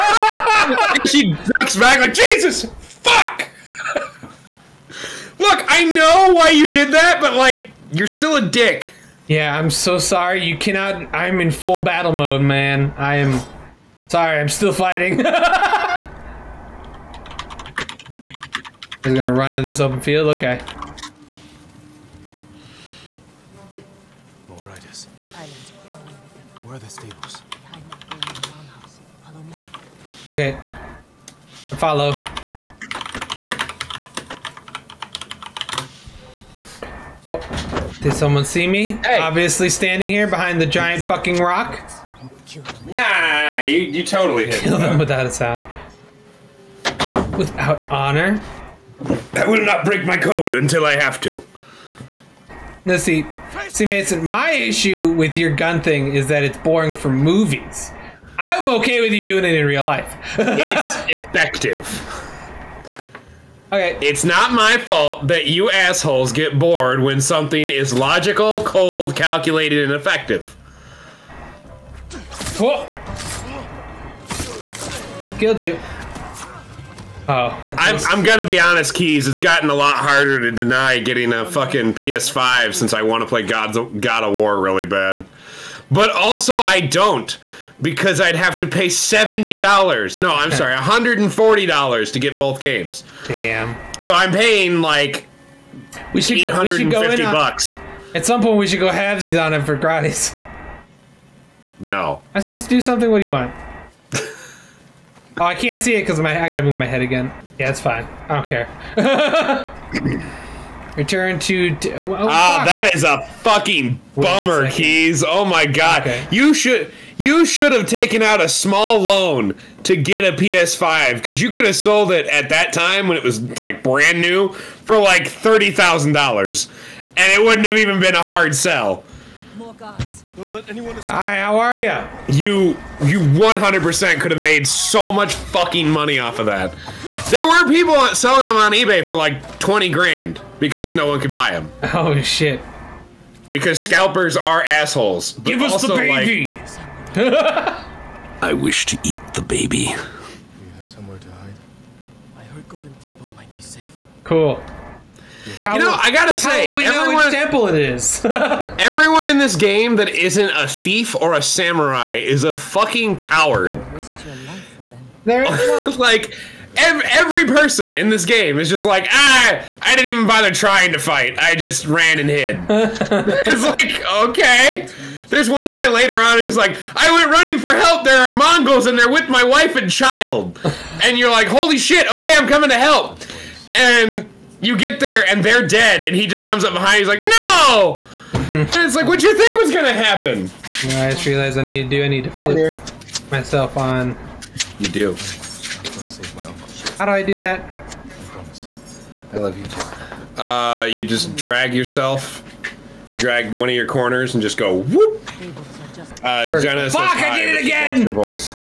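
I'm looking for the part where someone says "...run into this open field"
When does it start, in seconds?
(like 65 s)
19 s.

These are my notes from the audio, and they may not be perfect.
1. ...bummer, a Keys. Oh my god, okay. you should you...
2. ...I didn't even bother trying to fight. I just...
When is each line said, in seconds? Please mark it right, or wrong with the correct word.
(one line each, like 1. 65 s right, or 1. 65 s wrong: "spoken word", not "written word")
1. 114 s right
2. 169 s right.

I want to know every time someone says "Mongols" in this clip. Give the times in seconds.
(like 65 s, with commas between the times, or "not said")
178 s.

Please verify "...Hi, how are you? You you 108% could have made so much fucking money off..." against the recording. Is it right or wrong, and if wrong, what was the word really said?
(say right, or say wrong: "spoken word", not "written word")
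wrong: "100", not "108".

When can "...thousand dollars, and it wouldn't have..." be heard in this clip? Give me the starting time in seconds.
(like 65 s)
125 s.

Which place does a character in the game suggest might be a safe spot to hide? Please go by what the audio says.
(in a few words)
Golden Temple.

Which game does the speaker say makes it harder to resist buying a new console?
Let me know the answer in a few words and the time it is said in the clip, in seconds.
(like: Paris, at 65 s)
God of War, at 83 s.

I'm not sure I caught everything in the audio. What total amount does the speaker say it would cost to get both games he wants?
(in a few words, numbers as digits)
$140.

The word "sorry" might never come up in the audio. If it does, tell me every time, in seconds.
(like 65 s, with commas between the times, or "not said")
9 s, 14 s, 90 s.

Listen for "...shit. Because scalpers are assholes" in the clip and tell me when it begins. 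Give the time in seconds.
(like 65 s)
142 s.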